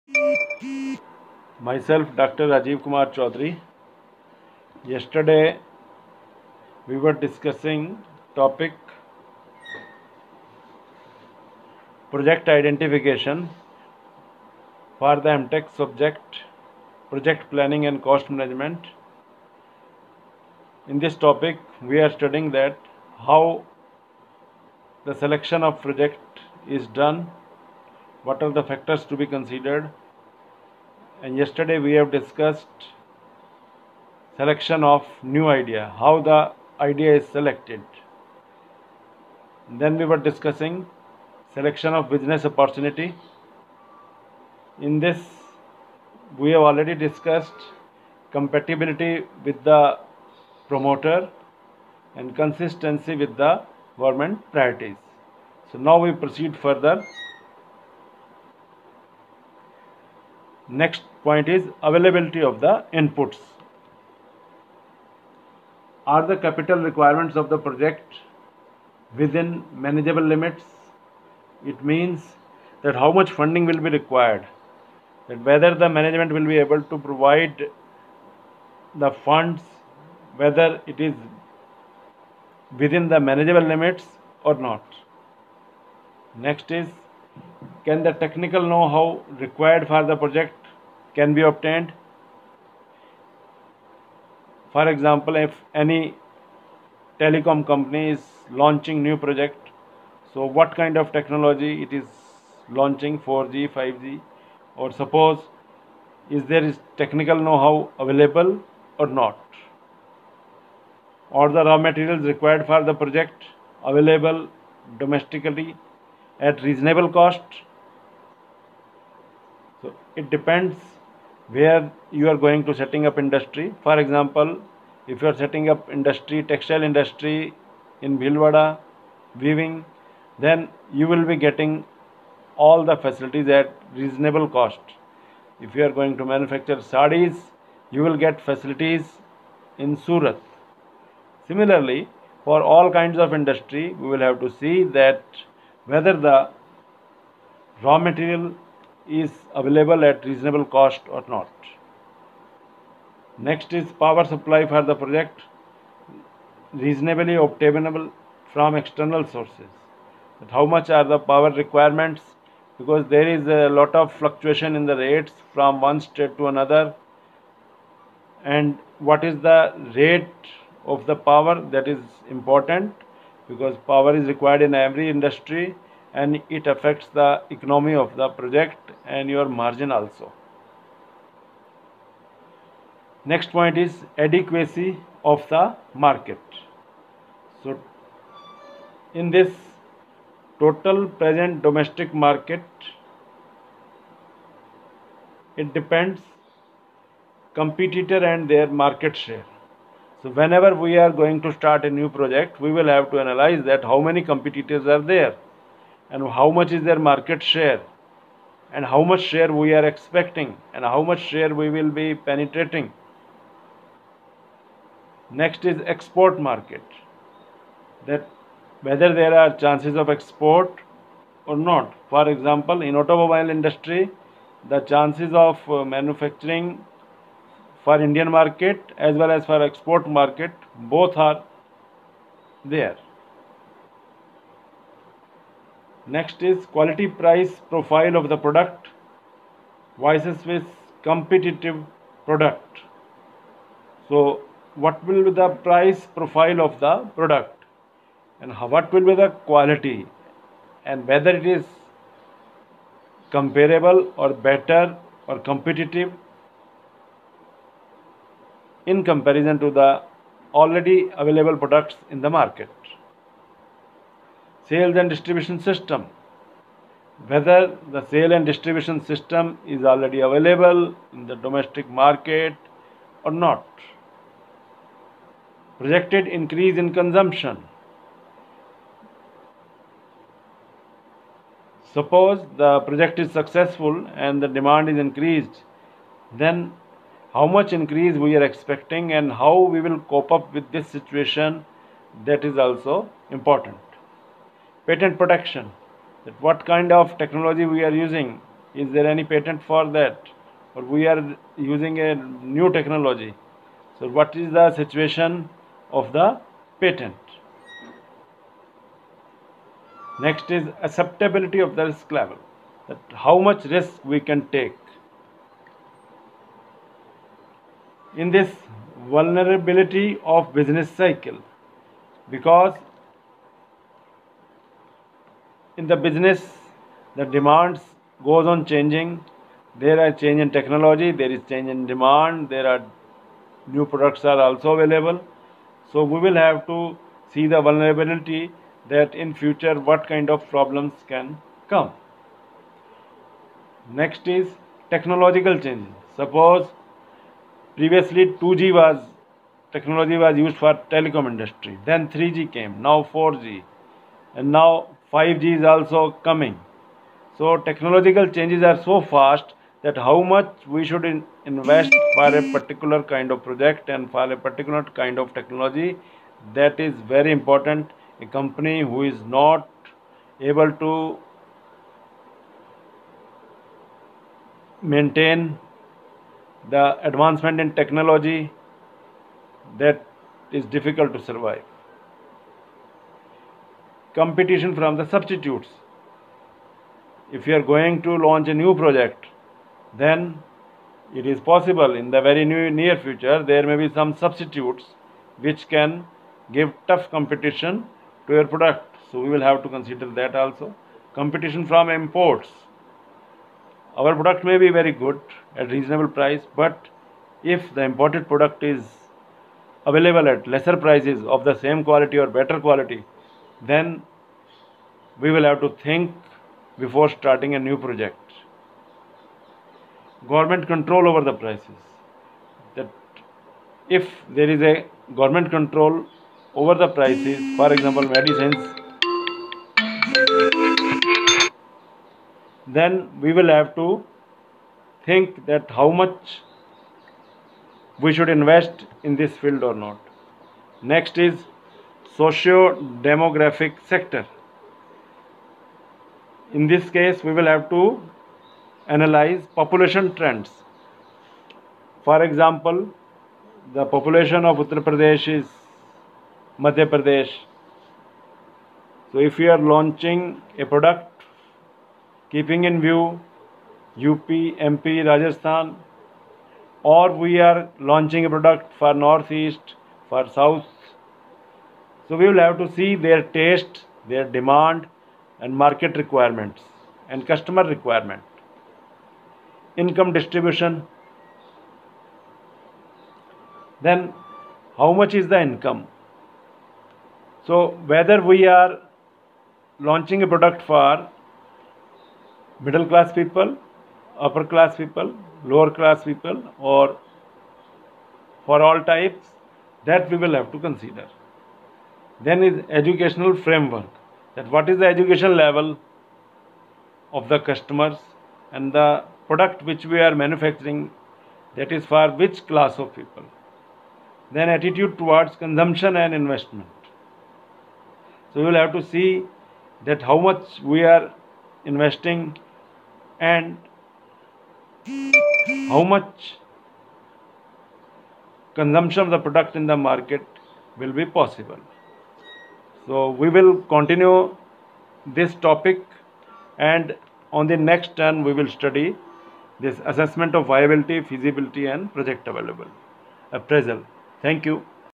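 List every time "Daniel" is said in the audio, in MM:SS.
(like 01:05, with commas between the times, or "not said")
not said.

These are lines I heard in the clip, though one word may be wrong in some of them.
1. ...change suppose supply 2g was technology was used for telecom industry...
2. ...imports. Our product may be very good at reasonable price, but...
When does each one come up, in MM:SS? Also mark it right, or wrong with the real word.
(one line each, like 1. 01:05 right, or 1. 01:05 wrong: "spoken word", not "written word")
1. 05:45 wrong: "previously", not "supply"
2. 06:41 right.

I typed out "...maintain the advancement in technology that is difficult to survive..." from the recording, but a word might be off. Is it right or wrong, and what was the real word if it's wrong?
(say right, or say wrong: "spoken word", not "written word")
right.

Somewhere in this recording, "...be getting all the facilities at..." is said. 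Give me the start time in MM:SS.
02:11.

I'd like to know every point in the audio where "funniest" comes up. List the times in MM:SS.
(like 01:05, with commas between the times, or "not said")
not said.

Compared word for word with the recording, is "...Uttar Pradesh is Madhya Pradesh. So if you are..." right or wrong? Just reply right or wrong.
right.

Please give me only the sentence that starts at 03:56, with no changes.
Next is quality price profile of the product versus with competitive product.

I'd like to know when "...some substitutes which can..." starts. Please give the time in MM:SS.
06:33.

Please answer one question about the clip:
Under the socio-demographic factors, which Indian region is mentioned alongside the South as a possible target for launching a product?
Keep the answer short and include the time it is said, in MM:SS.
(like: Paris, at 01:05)
Northeast, at 07:48.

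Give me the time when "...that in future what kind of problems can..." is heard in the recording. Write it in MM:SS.
05:38.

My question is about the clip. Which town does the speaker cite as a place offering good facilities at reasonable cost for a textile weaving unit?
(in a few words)
Bhilwara.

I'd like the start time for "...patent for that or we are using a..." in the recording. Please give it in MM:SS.
04:59.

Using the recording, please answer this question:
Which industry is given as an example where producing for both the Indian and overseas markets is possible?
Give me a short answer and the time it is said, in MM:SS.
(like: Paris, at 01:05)
Automobile industry, at 03:42.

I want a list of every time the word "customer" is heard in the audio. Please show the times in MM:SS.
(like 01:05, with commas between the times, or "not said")
07:57, 08:27.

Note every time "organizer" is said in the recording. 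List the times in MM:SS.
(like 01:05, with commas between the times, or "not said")
not said.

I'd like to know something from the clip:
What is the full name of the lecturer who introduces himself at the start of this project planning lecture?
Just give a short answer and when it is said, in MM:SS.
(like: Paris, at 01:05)
Rajiv Kumar Chaudhary, at 00:02.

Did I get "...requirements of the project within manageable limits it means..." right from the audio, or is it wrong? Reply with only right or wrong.
right.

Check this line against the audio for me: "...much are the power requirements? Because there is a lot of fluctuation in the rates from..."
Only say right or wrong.
right.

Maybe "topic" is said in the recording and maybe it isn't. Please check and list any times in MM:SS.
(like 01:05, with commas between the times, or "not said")
00:08, 00:21, 08:55.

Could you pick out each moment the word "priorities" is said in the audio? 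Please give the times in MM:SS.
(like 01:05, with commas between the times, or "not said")
00:54.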